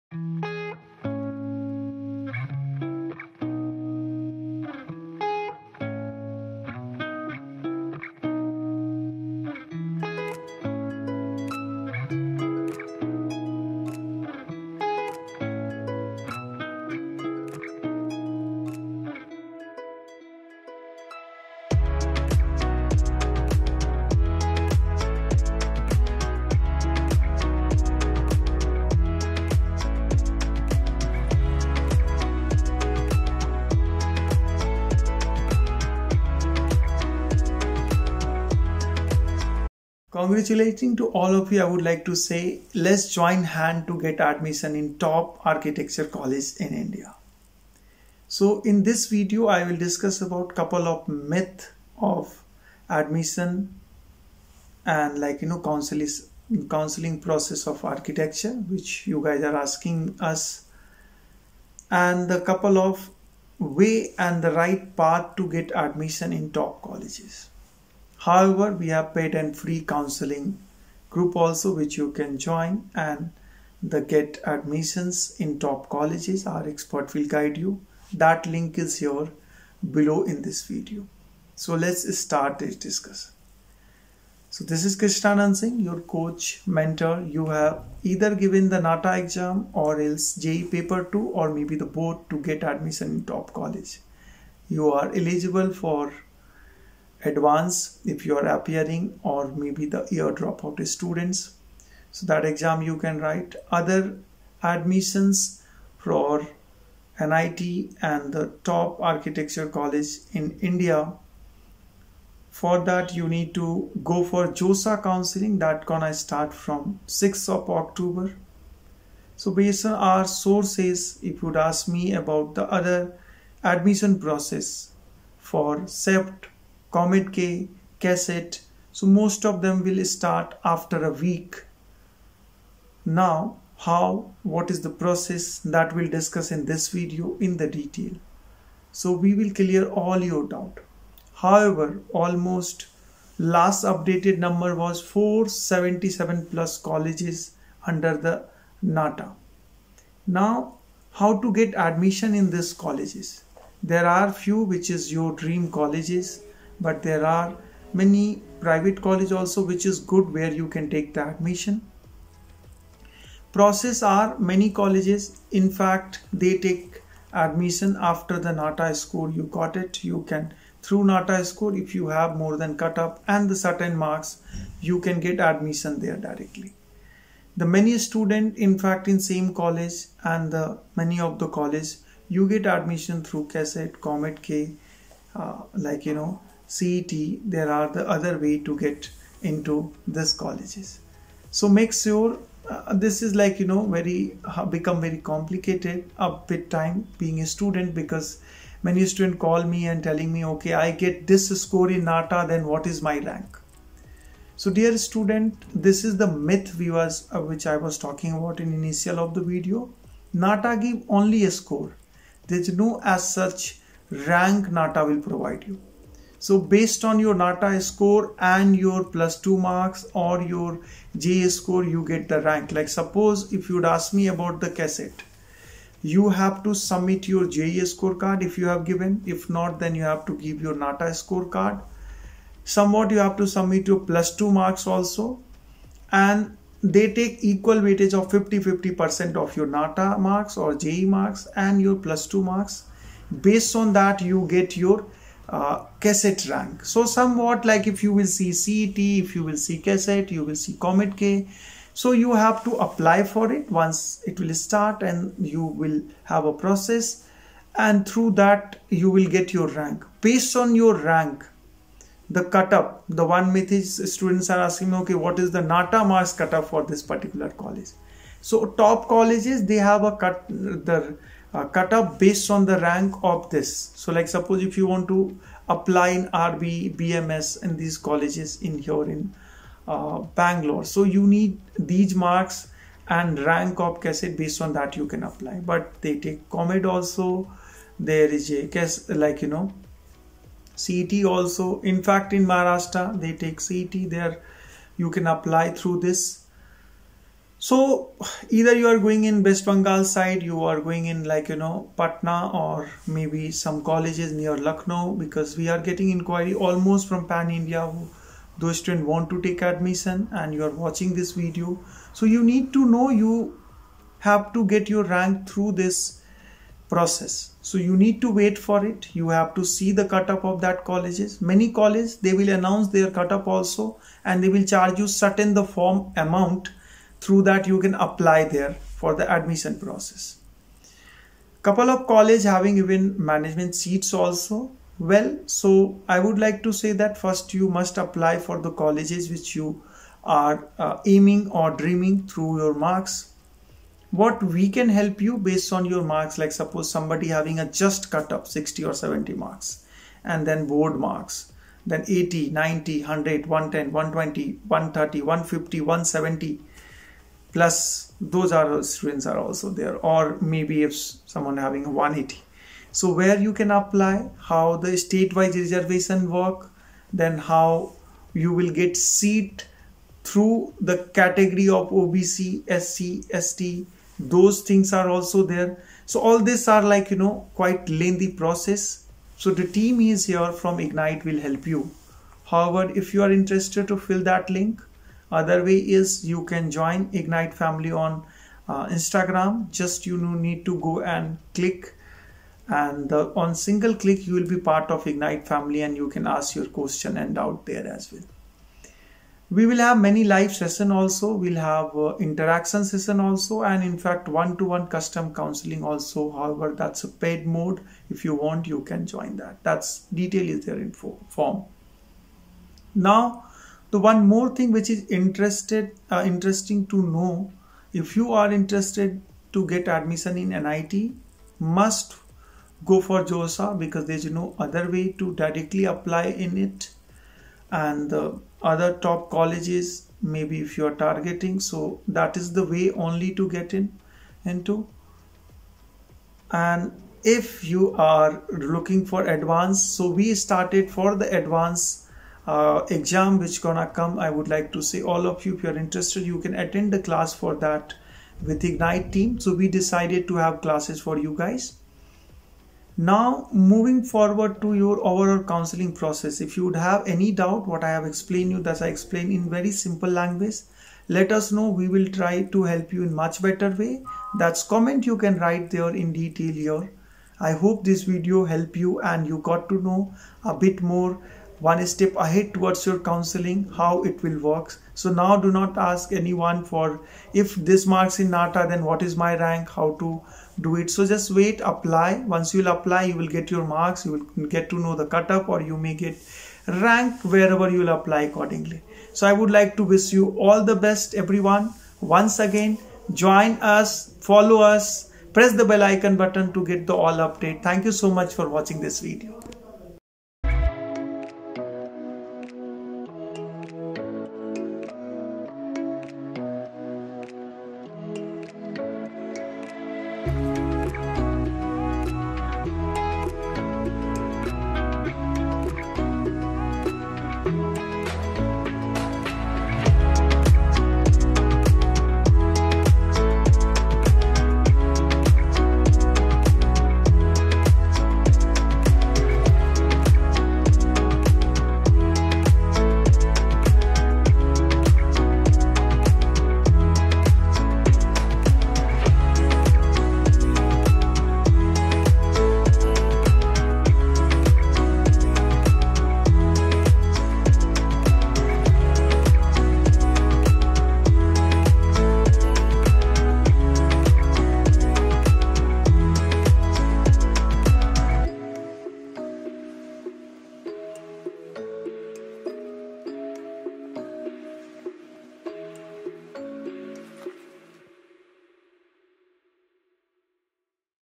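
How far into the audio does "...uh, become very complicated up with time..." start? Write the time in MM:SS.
03:14.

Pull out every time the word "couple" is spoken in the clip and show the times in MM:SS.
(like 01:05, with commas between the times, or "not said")
00:50, 01:02, 05:31.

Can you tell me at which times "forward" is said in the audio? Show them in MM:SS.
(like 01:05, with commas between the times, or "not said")
07:34.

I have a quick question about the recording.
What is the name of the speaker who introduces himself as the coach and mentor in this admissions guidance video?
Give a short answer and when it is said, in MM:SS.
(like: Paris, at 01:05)
Krishna Singh, at 01:24.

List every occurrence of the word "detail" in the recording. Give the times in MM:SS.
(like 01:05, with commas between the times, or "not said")
02:17, 06:50, 07:46.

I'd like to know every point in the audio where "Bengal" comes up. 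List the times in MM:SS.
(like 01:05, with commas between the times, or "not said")
04:59.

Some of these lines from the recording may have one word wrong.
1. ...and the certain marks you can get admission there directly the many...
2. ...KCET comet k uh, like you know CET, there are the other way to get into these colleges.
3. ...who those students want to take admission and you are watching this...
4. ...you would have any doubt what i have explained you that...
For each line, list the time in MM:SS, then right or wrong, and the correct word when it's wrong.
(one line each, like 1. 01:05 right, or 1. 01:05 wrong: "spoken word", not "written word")
1. 02:53 right
2. 03:03 right
3. 05:07 right
4. 07:36 right.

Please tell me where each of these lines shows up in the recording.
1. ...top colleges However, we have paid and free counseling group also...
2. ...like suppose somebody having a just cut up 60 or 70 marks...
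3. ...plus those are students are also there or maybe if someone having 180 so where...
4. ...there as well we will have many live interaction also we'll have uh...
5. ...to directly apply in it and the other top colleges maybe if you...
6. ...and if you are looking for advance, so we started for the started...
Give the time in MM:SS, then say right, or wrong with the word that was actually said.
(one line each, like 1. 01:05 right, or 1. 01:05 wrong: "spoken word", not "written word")
1. 01:06 right
2. 05:46 right
3. 05:57 right
4. 06:37 wrong: "session", not "interaction"
5. 07:05 right
6. 07:16 wrong: "advanced", not "started".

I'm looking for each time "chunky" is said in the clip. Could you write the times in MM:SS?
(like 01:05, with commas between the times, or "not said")
not said.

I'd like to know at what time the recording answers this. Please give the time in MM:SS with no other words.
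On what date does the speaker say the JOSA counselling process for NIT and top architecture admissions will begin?
01:57.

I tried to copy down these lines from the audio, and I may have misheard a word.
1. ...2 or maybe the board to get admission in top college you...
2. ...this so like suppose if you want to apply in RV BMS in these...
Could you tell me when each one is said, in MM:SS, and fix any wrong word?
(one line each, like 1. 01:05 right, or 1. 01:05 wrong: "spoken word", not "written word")
1. 01:31 right
2. 04:33 right.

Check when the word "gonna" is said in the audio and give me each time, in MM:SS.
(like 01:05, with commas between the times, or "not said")
01:55, 07:23.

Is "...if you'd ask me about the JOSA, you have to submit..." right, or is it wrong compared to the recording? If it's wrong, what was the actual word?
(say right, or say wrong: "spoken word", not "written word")
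wrong: "KCET", not "JOSA".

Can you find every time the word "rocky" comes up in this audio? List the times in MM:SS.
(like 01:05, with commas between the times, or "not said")
not said.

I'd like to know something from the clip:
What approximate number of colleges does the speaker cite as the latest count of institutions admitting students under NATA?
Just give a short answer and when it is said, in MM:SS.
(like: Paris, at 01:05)
477, at 02:25.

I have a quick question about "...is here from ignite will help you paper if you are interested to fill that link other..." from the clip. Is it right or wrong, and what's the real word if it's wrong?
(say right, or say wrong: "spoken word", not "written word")
wrong: "however", not "paper".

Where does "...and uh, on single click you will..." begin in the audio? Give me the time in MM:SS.
06:32.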